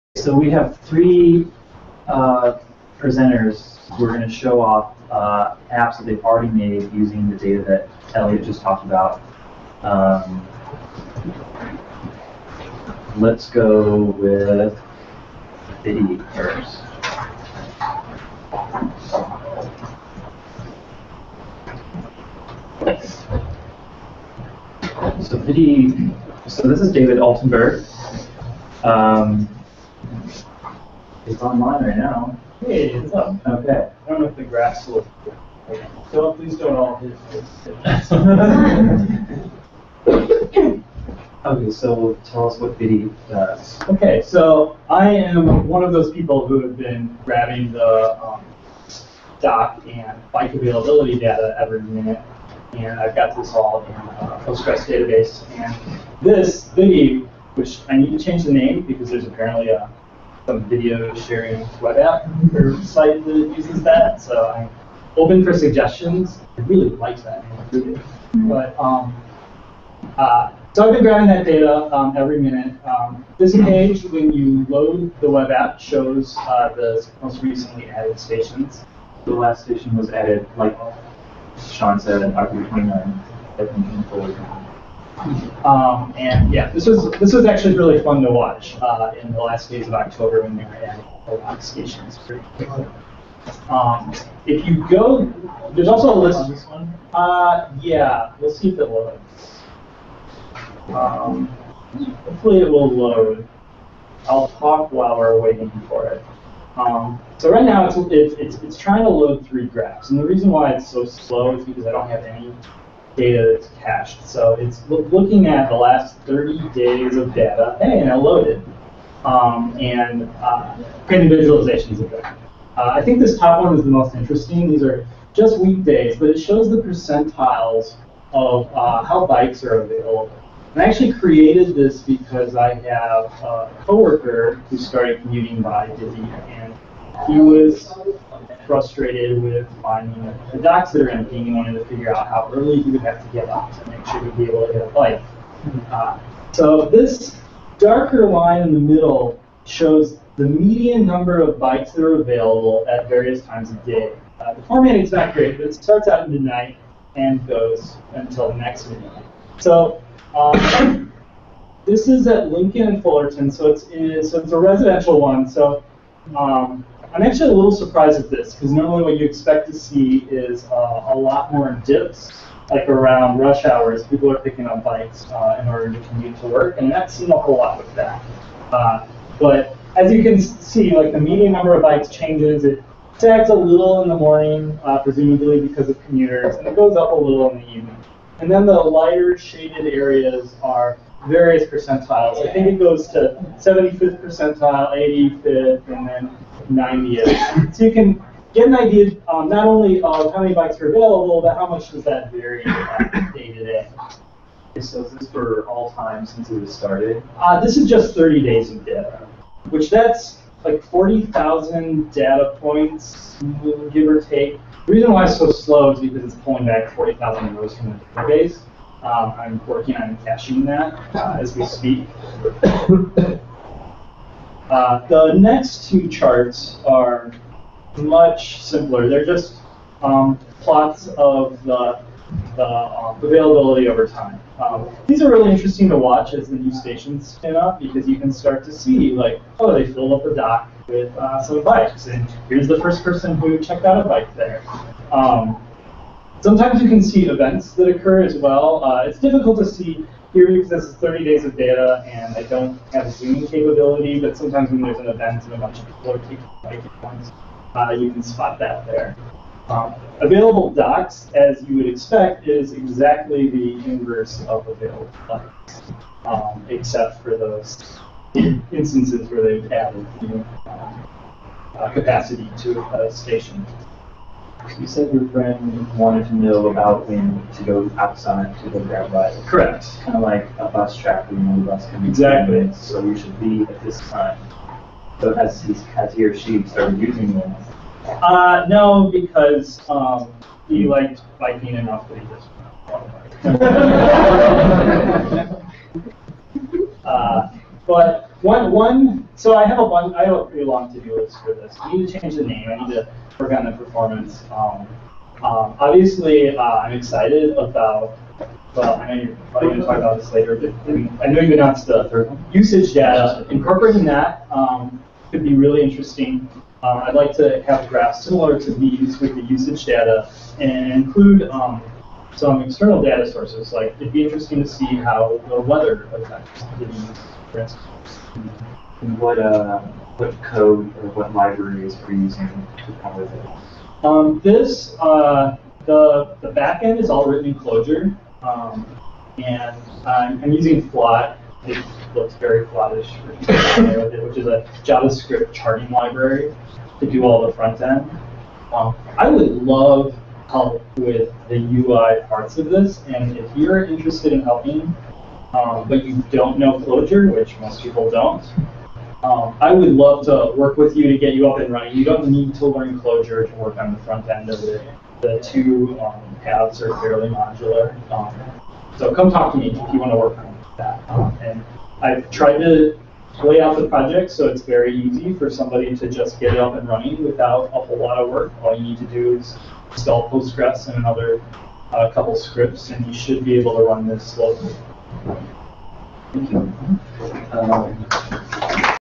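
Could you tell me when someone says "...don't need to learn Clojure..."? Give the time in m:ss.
6:02.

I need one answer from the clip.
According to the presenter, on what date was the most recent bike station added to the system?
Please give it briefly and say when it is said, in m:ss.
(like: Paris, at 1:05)
October 29, at 1:22.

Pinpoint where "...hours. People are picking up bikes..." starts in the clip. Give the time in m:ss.
2:53.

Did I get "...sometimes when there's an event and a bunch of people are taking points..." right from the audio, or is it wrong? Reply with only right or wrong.
right.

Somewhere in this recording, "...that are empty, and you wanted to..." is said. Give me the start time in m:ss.
2:20.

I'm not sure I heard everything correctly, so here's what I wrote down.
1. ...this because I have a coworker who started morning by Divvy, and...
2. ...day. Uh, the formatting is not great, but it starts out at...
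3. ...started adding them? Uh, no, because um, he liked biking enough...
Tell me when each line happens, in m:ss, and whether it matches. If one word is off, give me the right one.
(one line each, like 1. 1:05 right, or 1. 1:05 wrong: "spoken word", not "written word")
1. 2:11 wrong: "commuting", not "morning"
2. 2:33 right
3. 4:46 wrong: "using", not "adding".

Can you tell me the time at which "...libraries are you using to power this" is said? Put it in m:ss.
5:31.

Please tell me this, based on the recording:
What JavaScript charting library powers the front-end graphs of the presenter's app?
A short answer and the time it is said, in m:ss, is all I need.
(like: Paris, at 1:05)
Flot, at 5:40.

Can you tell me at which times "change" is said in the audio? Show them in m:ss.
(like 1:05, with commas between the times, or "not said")
0:58, 3:02, 5:02.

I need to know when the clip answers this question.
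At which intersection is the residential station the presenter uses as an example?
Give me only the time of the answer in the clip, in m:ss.
2:42.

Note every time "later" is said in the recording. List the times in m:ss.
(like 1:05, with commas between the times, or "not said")
5:10.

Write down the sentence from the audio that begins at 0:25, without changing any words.
So Viddy, so this is David Altenberg.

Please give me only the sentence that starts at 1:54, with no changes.
So it's looking at the last 30 days of data.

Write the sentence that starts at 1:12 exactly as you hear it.
Um, this page, when you load the web app, shows uh, the most recently added stations.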